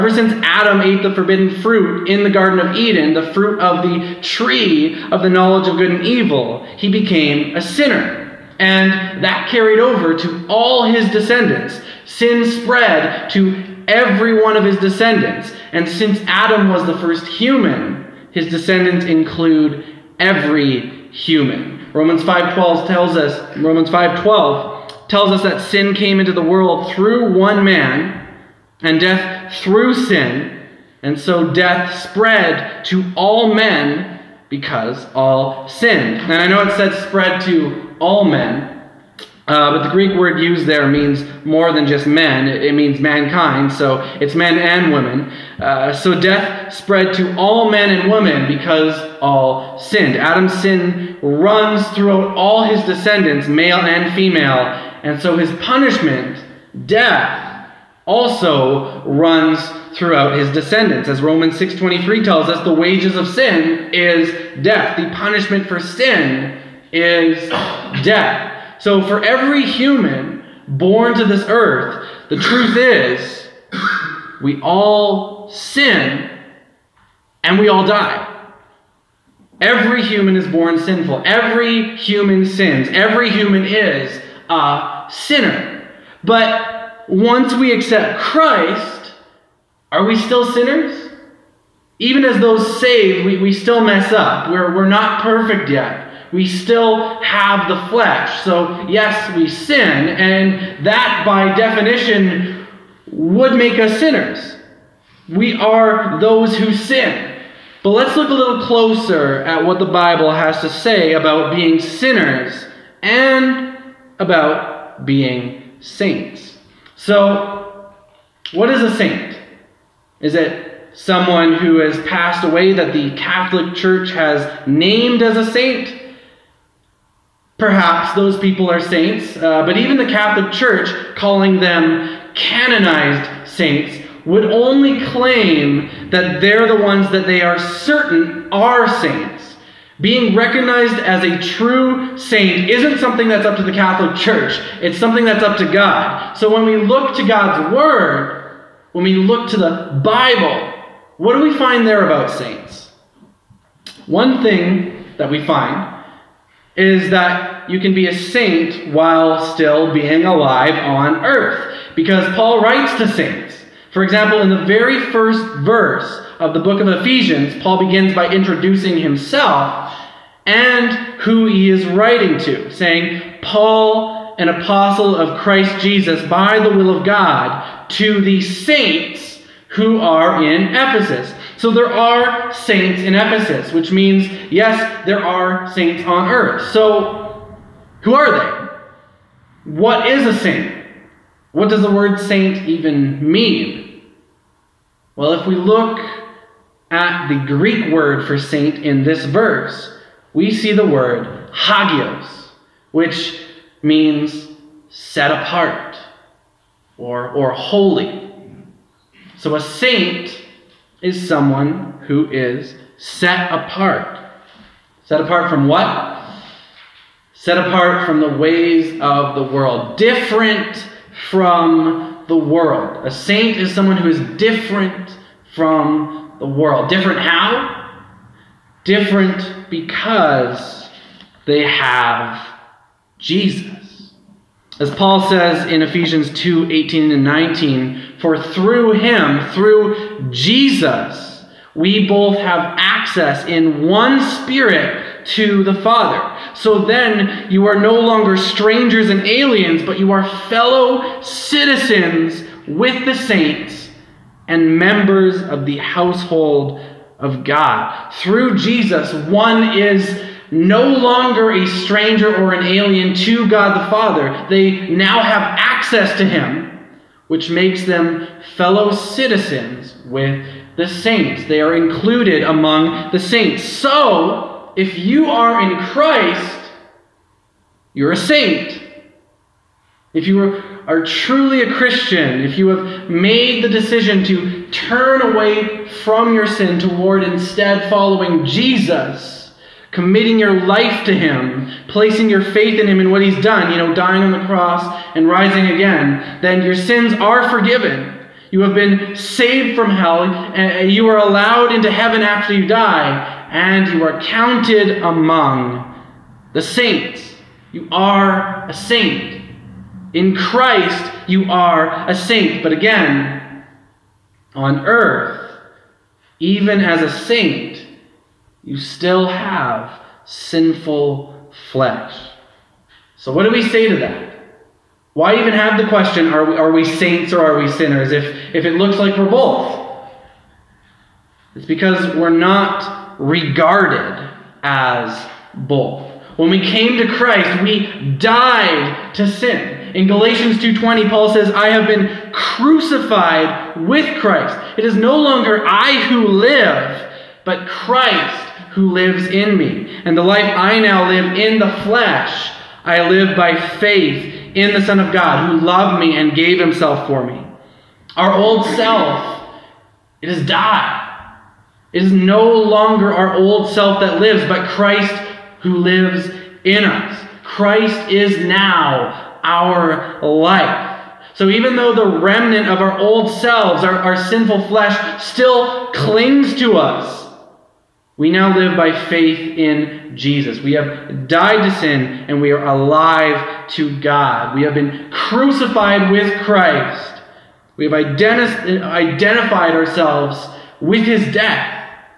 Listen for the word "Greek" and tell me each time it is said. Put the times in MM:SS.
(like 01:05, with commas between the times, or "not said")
00:39, 03:17.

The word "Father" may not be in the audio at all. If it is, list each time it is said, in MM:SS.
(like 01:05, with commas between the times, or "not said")
04:05, 04:23.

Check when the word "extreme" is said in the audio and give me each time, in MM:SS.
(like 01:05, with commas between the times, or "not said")
not said.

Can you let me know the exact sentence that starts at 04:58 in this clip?
You have been saved from hell, and you are allowed into heaven after you die, and you are counted among the saints.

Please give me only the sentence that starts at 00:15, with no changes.
And since Adam was the first human, his descendants include every human.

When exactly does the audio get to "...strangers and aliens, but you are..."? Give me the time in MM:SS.
04:08.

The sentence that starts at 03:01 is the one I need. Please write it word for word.
So there are saints in Ephesus, which means, yes, there are saints on earth.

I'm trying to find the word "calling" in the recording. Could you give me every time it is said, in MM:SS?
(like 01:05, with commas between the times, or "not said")
02:11.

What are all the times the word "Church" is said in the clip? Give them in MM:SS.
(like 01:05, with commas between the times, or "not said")
02:03, 02:10, 02:24.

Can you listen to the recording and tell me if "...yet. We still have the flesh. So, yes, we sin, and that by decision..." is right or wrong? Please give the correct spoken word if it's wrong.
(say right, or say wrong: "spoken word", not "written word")
wrong: "definition", not "decision".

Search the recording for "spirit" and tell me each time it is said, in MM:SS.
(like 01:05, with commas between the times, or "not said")
04:04.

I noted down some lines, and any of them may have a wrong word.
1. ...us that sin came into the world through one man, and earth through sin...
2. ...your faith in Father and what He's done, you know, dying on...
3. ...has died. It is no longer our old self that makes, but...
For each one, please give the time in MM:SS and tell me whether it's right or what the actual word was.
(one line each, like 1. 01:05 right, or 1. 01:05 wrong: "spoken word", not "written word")
1. 00:25 wrong: "death", not "earth"
2. 04:52 wrong: "Him", not "Father"
3. 06:00 wrong: "lives", not "makes".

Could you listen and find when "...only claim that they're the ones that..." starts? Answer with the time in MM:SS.
02:14.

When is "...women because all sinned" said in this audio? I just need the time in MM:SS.
00:48.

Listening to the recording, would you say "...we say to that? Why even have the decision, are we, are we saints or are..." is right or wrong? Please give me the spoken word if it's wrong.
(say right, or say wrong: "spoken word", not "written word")
wrong: "question", not "decision".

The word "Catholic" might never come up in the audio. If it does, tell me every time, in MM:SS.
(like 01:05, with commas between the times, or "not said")
02:03, 02:10, 02:23.